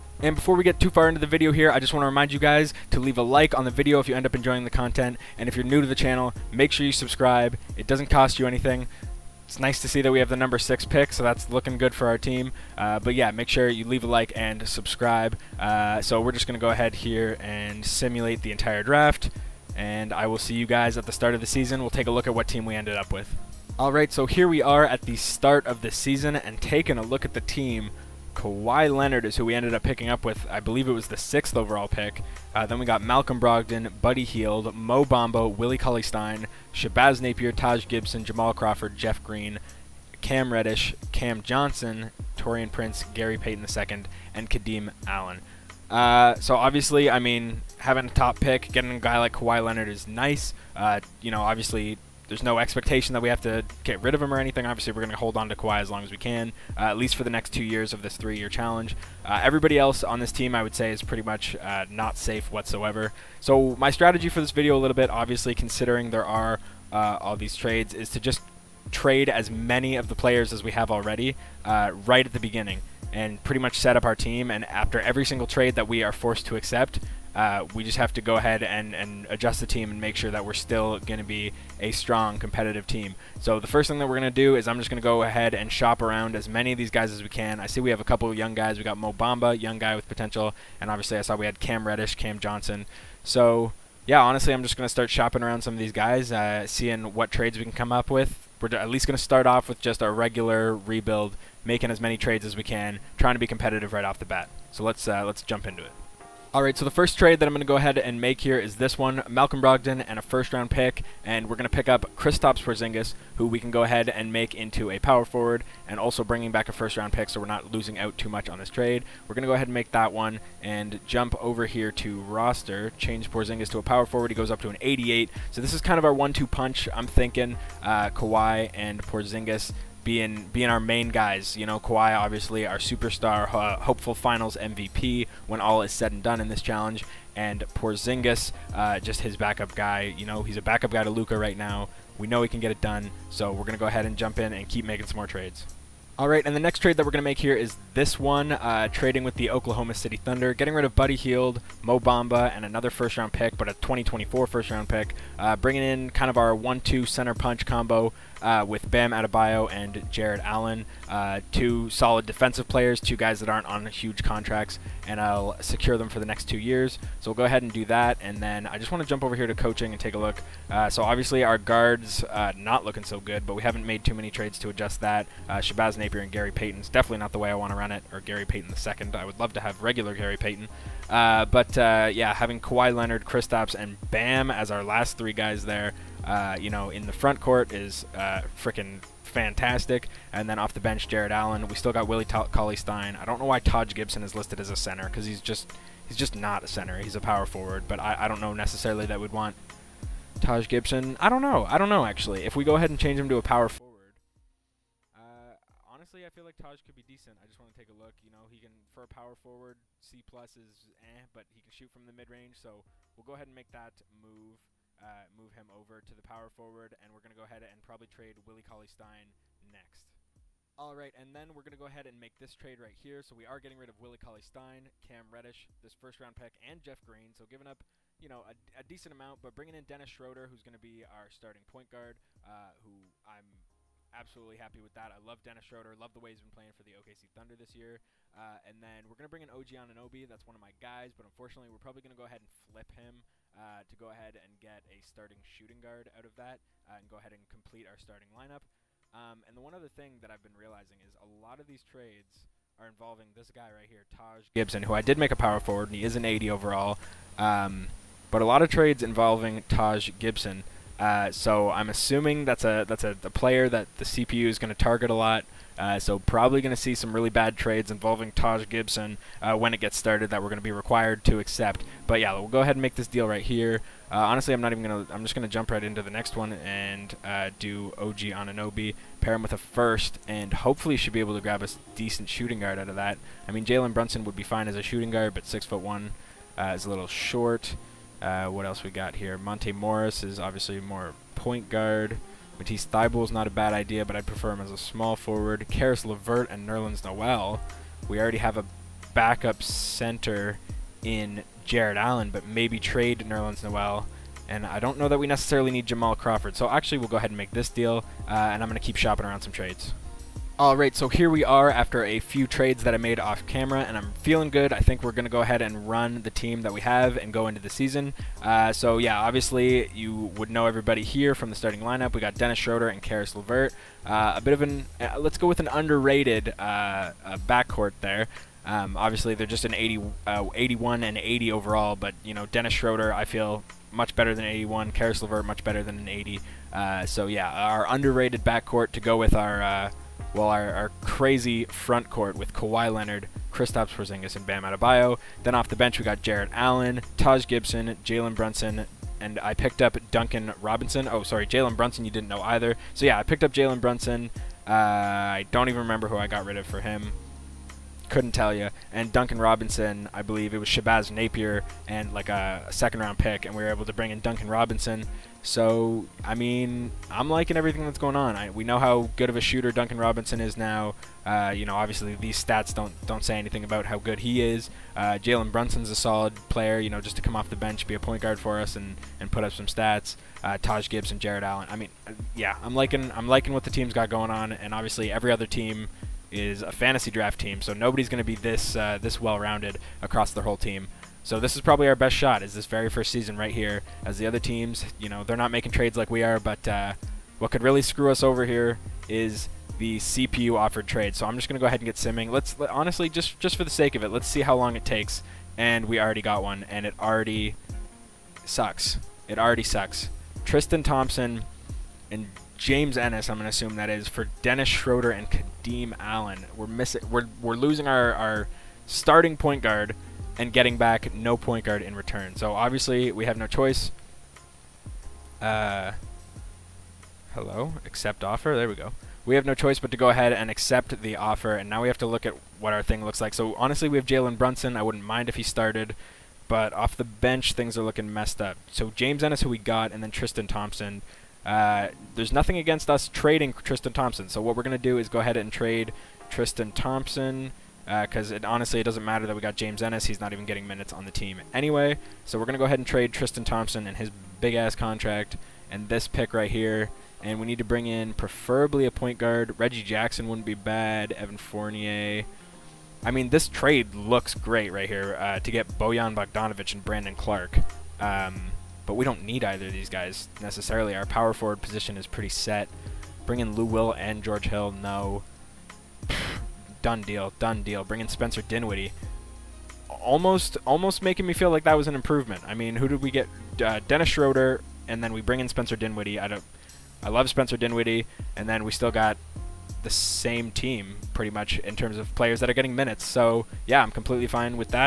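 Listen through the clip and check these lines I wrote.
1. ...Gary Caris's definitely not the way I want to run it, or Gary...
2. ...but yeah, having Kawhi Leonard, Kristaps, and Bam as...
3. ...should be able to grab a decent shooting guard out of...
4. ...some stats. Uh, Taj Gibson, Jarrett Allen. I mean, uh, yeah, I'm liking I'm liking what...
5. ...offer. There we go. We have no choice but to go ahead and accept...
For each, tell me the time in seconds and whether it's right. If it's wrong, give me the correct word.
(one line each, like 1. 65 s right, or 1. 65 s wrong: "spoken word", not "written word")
1. 176 s wrong: "Payton", not "Caris"
2. 181 s right
3. 280 s right
4. 379 s right
5. 428 s right.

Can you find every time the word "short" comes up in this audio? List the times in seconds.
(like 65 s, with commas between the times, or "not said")
287 s.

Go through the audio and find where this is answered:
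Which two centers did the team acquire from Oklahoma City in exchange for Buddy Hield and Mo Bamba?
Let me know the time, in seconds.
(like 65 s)
158 s.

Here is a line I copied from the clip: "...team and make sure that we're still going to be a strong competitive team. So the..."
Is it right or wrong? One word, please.
right.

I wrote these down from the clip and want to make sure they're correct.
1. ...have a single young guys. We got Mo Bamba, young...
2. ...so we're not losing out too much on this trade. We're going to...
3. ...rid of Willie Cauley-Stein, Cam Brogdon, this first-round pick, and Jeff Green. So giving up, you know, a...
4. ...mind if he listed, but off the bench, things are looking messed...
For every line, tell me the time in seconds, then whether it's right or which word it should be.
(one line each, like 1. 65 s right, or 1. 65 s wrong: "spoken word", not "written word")
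1. 87 s wrong: "couple", not "single"
2. 117 s right
3. 223 s wrong: "Reddish", not "Brogdon"
4. 435 s wrong: "started", not "listed".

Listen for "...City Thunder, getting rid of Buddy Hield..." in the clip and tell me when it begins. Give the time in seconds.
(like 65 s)
149 s.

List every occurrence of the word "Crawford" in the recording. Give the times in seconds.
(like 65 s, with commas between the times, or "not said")
38 s, 306 s.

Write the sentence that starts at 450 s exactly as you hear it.
He's not even getting minutes on the team anyway.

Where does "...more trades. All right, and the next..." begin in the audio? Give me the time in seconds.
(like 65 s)
145 s.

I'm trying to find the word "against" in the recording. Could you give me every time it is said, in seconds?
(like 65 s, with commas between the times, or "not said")
442 s.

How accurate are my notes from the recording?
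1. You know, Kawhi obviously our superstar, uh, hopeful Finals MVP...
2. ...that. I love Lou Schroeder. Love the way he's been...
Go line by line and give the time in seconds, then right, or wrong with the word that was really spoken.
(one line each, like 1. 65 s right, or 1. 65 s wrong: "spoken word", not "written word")
1. 131 s right
2. 234 s wrong: "Dennis", not "Lou".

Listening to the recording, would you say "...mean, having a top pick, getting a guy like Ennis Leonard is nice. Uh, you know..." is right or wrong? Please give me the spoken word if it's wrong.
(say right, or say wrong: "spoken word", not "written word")
wrong: "Kawhi", not "Ennis".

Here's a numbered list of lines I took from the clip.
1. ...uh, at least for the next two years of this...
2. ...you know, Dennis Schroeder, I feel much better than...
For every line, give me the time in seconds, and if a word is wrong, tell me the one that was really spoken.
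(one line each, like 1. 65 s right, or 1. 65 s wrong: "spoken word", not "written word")
1. 56 s right
2. 332 s right.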